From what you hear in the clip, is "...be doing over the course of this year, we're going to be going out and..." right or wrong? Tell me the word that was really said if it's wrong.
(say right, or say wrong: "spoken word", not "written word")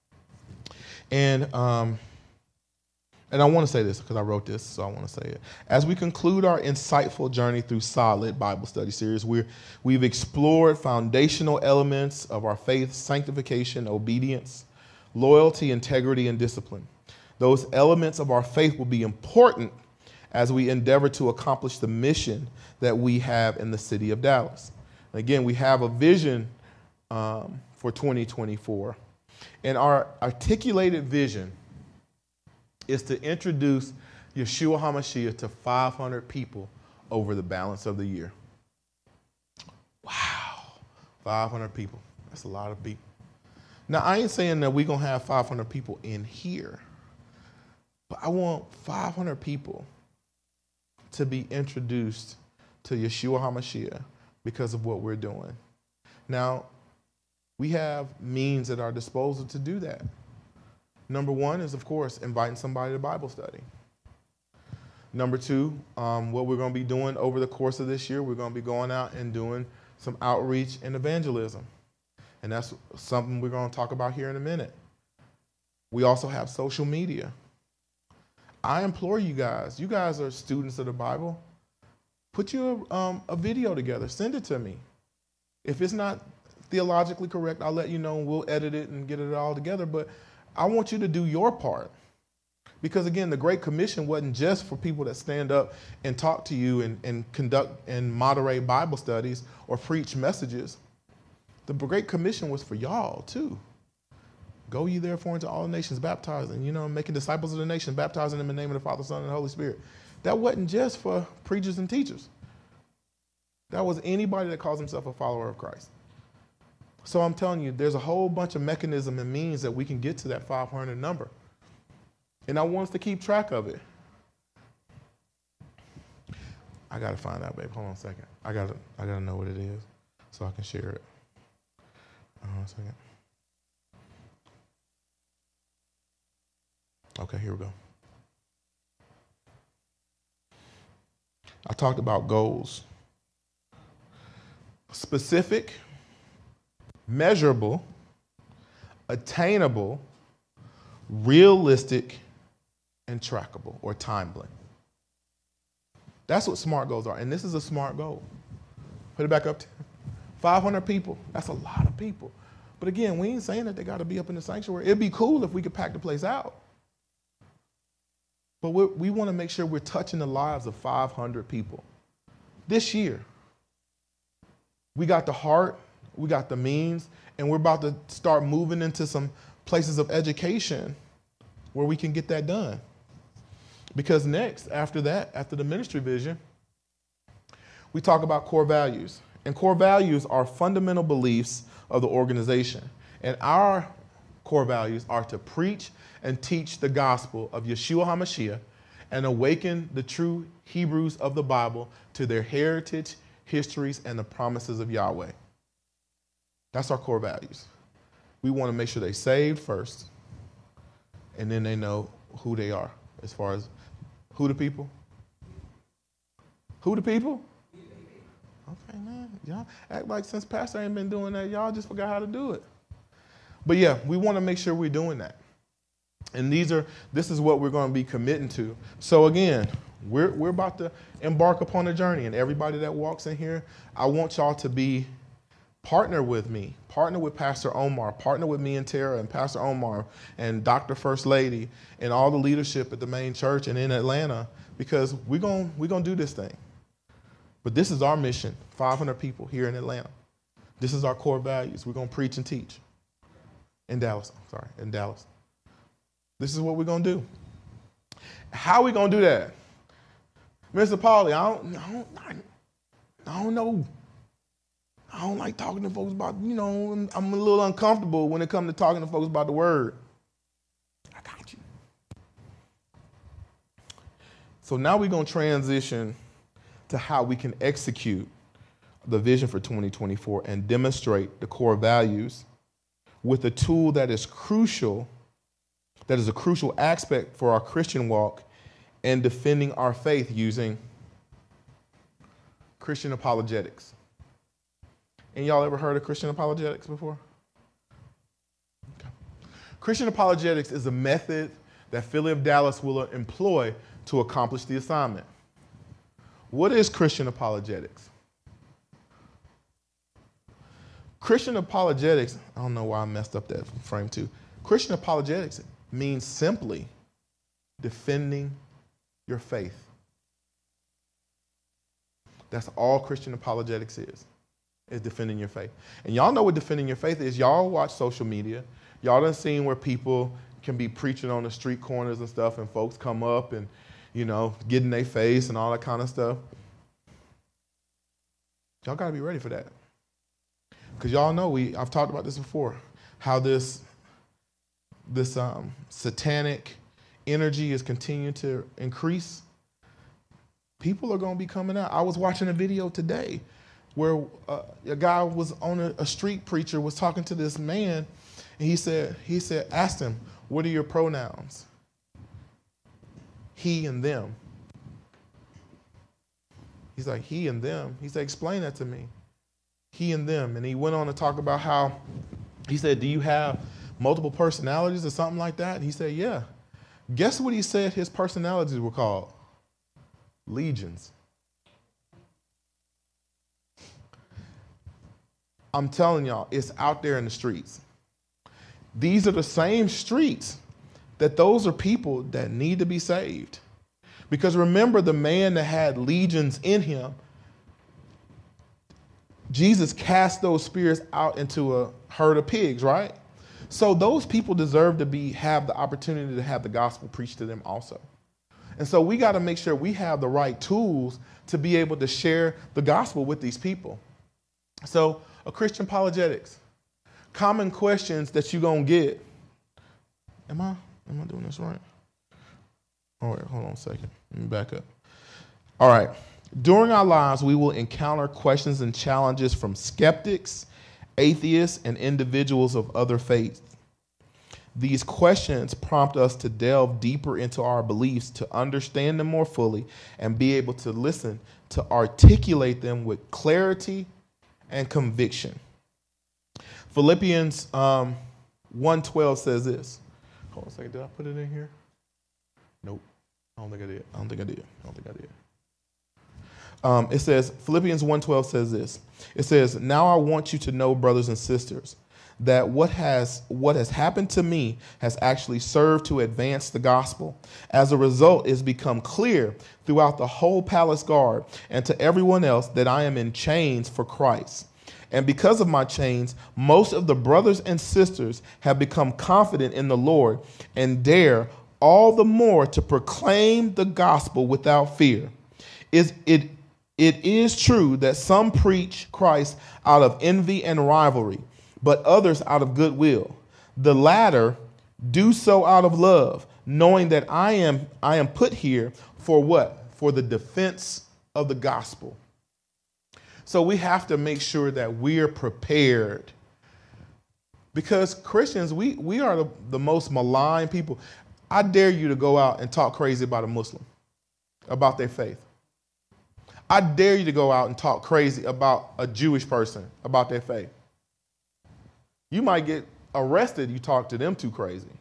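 right.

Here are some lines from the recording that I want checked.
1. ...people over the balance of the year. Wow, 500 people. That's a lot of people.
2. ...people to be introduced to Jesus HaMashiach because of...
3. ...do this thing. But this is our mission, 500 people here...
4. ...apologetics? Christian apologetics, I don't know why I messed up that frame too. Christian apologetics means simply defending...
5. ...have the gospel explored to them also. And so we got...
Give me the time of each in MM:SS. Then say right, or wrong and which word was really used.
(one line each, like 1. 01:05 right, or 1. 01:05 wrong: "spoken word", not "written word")
1. 00:36 right
2. 00:49 wrong: "Yeshua", not "Jesus"
3. 04:06 right
4. 05:07 right
5. 06:46 wrong: "preached", not "explored".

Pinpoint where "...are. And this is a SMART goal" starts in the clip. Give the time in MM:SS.
02:37.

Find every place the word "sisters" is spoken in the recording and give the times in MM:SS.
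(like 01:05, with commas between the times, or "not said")
07:41, 07:57.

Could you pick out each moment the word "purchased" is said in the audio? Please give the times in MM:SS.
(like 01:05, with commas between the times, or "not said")
not said.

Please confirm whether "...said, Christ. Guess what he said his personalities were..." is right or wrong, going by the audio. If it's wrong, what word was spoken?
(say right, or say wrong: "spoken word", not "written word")
wrong: "Yeah", not "Christ".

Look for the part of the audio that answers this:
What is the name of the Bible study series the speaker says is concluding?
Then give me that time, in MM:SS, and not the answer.
00:07.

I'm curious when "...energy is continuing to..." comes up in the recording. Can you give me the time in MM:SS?
05:47.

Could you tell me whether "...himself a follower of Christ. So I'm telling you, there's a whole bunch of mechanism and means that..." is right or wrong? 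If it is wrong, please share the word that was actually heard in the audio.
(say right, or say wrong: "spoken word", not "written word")
right.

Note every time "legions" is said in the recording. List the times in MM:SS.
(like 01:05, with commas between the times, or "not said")
06:20, 06:35.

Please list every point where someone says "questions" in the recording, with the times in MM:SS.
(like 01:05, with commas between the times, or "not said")
06:57, 07:08, 07:15.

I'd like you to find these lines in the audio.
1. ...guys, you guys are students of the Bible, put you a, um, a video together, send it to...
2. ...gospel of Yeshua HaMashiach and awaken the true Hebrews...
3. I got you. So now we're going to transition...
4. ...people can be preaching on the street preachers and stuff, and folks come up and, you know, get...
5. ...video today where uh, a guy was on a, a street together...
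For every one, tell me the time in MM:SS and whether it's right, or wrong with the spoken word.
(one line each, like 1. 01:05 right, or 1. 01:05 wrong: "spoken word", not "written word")
1. 01:19 right
2. 03:16 right
3. 04:31 right
4. 05:29 wrong: "corners", not "preachers"
5. 05:52 wrong: "preacher", not "together".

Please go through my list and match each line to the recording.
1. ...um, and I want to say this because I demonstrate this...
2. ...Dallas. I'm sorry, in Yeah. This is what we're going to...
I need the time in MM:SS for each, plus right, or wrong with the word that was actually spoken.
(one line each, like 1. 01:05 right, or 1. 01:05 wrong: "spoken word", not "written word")
1. 00:01 wrong: "wrote", not "demonstrate"
2. 04:13 wrong: "Dallas", not "Yeah".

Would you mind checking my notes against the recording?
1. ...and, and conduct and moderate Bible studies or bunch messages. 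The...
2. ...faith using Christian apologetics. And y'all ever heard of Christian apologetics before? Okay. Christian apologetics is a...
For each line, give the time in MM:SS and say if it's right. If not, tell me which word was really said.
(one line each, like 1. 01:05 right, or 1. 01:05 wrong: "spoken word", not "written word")
1. 01:36 wrong: "preach", not "bunch"
2. 04:49 right.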